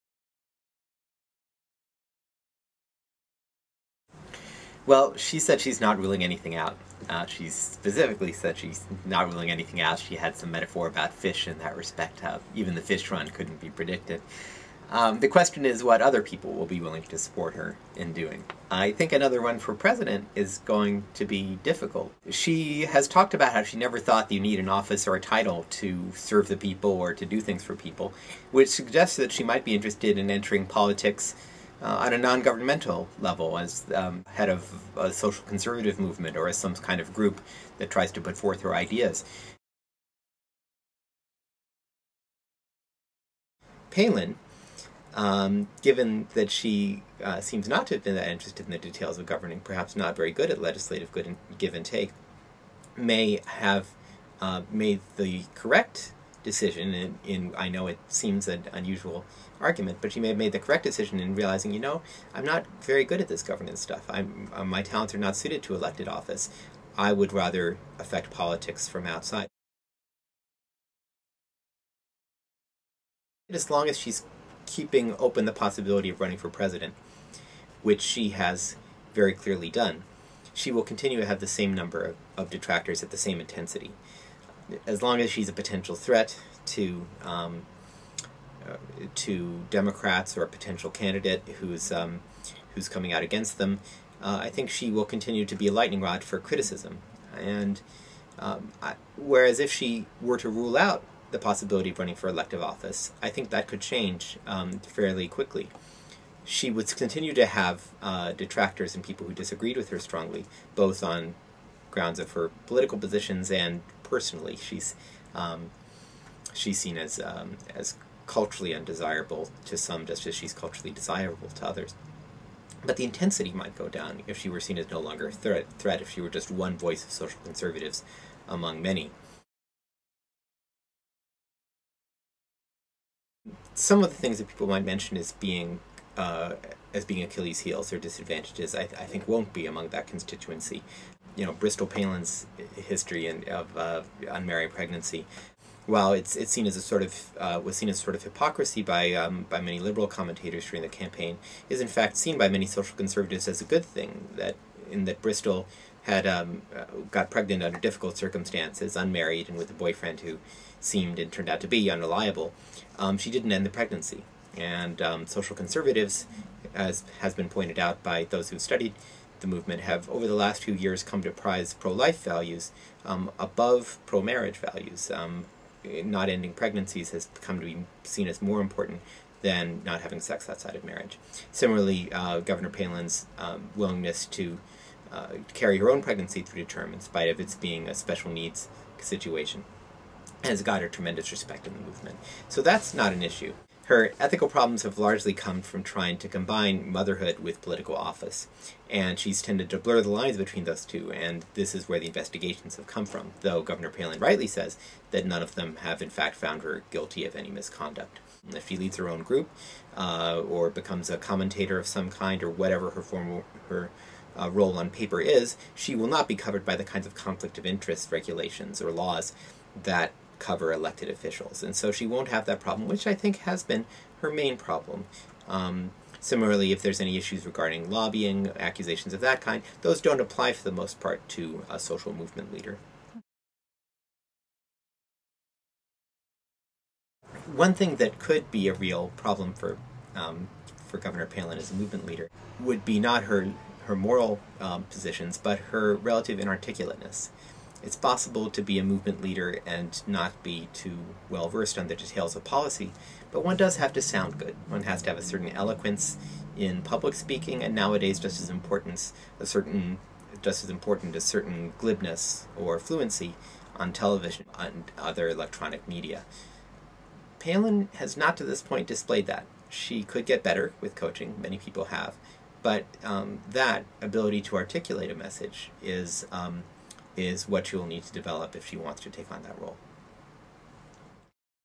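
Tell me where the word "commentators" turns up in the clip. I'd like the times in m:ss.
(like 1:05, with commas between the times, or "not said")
2:30, 3:31.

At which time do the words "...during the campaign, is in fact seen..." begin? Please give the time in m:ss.
2:30.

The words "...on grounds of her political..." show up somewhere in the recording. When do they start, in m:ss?
1:51.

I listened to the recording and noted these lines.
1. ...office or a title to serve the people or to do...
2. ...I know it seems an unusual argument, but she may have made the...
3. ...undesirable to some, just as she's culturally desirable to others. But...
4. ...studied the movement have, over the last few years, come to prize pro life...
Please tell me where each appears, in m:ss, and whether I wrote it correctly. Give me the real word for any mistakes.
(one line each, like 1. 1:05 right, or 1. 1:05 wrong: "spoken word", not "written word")
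1. 0:24 right
2. 0:57 right
3. 1:58 right
4. 2:48 right.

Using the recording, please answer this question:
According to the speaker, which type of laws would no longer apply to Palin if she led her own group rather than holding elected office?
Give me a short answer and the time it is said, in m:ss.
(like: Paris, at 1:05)
Conflict of interest, at 3:37.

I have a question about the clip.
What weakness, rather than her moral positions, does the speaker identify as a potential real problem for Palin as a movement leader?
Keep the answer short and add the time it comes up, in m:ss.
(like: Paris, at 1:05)
Inarticulateness, at 4:06.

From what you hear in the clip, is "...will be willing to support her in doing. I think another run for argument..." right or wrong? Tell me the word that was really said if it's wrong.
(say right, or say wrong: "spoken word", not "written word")
wrong: "president", not "argument".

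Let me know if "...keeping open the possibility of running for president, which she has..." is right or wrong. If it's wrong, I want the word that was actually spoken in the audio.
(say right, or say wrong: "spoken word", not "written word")
right.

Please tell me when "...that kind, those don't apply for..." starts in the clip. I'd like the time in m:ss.
3:49.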